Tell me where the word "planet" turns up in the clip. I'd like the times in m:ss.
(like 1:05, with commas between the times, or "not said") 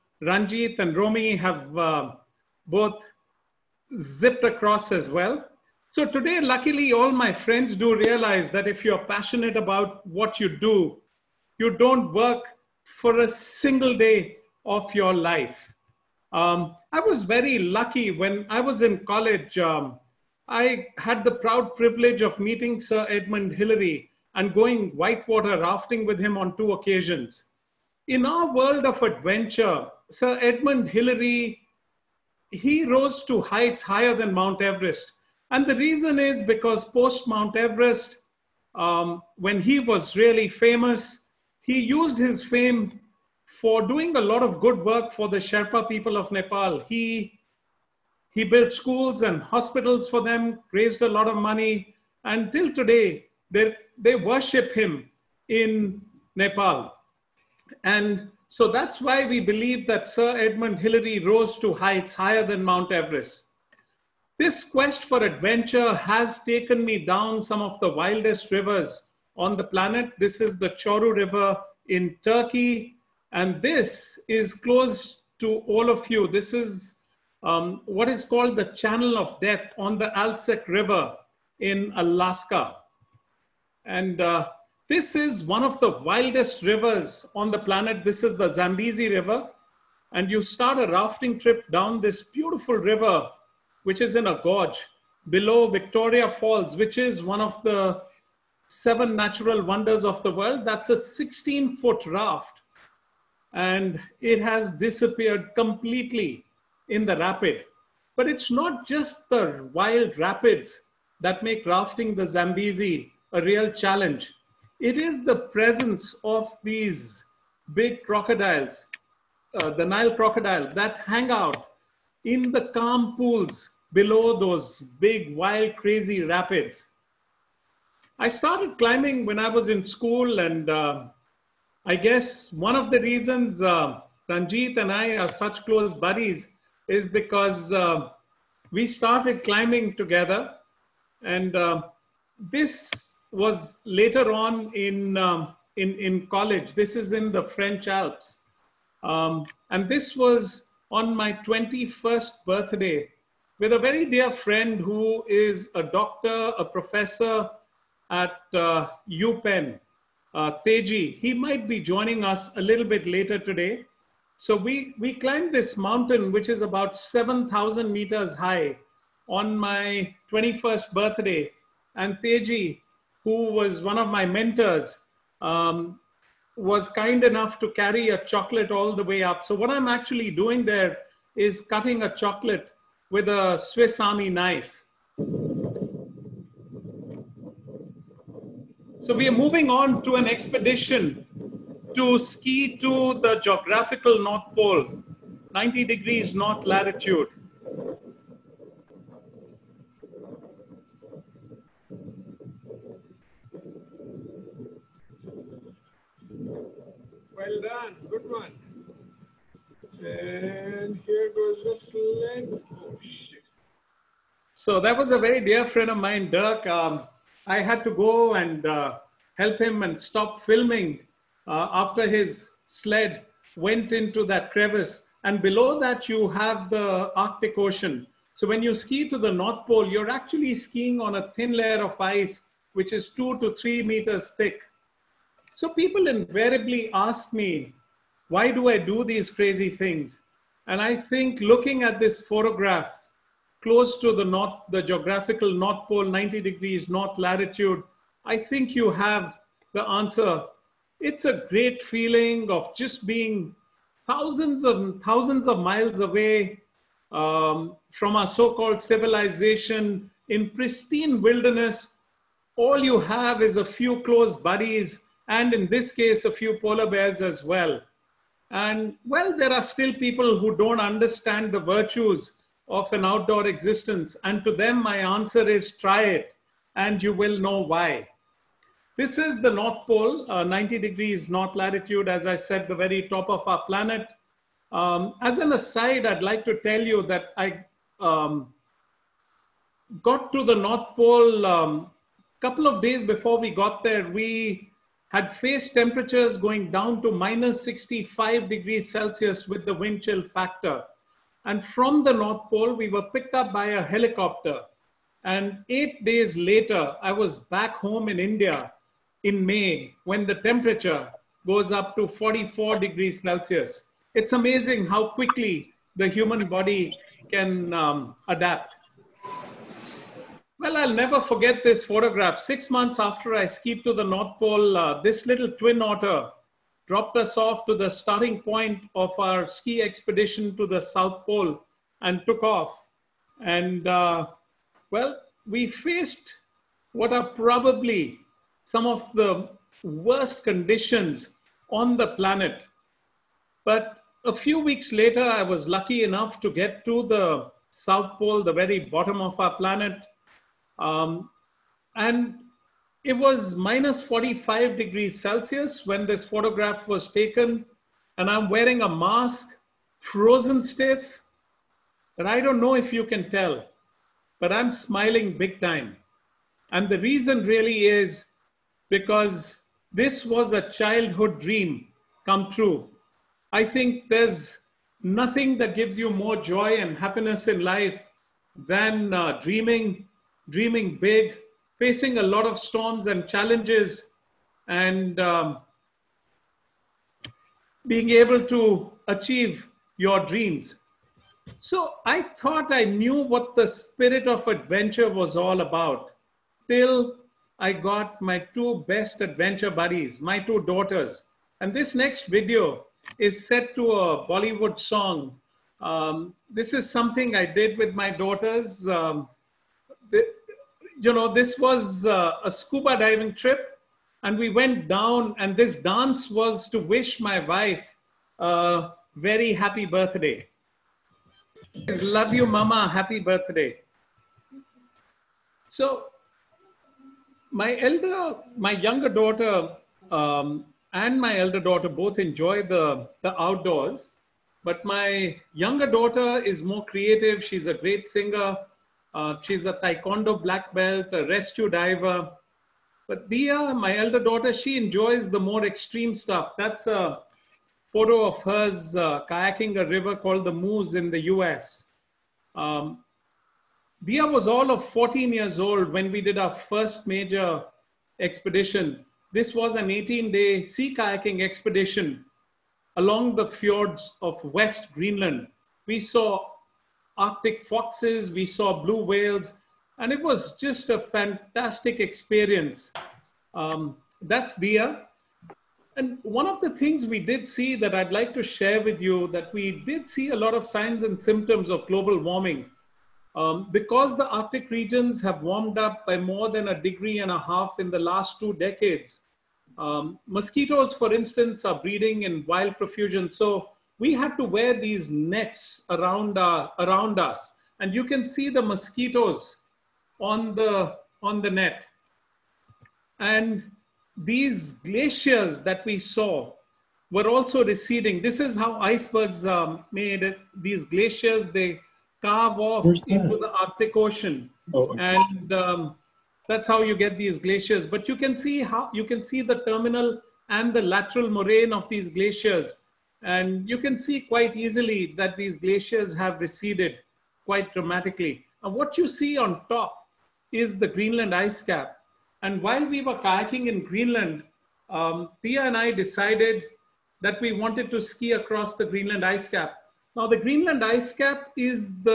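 1:09, 1:27, 4:43, 5:42, 5:49.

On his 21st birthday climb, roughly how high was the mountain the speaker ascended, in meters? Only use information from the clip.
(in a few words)
7,000 meters.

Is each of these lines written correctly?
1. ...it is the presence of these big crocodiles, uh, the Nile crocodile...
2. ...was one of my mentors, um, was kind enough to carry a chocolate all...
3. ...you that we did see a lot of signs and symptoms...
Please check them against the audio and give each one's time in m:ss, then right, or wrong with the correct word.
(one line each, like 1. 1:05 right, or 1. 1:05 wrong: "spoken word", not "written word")
1. 1:54 right
2. 2:53 right
3. 7:58 right.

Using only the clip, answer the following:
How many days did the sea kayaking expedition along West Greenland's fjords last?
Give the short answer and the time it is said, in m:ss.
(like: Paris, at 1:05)
18 days, at 7:39.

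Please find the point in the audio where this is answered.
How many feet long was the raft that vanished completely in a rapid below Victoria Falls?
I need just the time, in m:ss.
1:40.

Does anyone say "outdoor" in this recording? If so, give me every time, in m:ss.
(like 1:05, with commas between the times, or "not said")
4:33, 7:13.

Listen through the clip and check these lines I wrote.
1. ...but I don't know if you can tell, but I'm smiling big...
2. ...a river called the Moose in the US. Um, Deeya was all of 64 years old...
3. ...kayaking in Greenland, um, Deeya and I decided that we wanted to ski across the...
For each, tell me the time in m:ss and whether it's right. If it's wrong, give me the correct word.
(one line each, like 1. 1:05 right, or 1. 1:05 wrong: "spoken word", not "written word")
1. 6:02 right
2. 7:29 wrong: "14", not "64"
3. 8:53 right.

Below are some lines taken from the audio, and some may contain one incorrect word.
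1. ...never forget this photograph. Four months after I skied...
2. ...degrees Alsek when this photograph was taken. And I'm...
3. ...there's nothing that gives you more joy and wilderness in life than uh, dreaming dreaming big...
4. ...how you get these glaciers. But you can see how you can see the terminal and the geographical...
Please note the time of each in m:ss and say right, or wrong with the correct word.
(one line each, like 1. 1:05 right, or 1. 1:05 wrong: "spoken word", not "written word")
1. 5:20 wrong: "Six", not "Four"
2. 5:54 wrong: "Celsius", not "Alsek"
3. 6:14 wrong: "happiness", not "wilderness"
4. 8:36 wrong: "lateral", not "geographical".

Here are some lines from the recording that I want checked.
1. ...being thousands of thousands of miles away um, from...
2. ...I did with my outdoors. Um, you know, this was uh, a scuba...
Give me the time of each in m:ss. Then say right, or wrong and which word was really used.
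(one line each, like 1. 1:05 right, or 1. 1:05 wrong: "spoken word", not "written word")
1. 4:13 right
2. 6:47 wrong: "daughters", not "outdoors".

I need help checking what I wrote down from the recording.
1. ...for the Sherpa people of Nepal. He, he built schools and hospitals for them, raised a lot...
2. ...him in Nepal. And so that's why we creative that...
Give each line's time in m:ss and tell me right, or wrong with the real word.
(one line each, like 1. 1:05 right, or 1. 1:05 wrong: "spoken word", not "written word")
1. 0:45 right
2. 0:54 wrong: "believe", not "creative".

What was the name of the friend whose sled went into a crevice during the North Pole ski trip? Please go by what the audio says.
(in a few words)
Dirk.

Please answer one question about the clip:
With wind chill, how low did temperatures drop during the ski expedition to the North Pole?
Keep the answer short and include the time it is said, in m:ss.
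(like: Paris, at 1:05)
minus 65 degrees Celsius, at 4:57.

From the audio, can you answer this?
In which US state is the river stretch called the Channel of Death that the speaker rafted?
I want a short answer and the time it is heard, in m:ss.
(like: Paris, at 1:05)
Alaska, at 1:21.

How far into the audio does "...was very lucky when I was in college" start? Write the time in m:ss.
0:17.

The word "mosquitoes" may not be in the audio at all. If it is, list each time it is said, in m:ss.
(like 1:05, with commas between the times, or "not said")
8:10, 8:18.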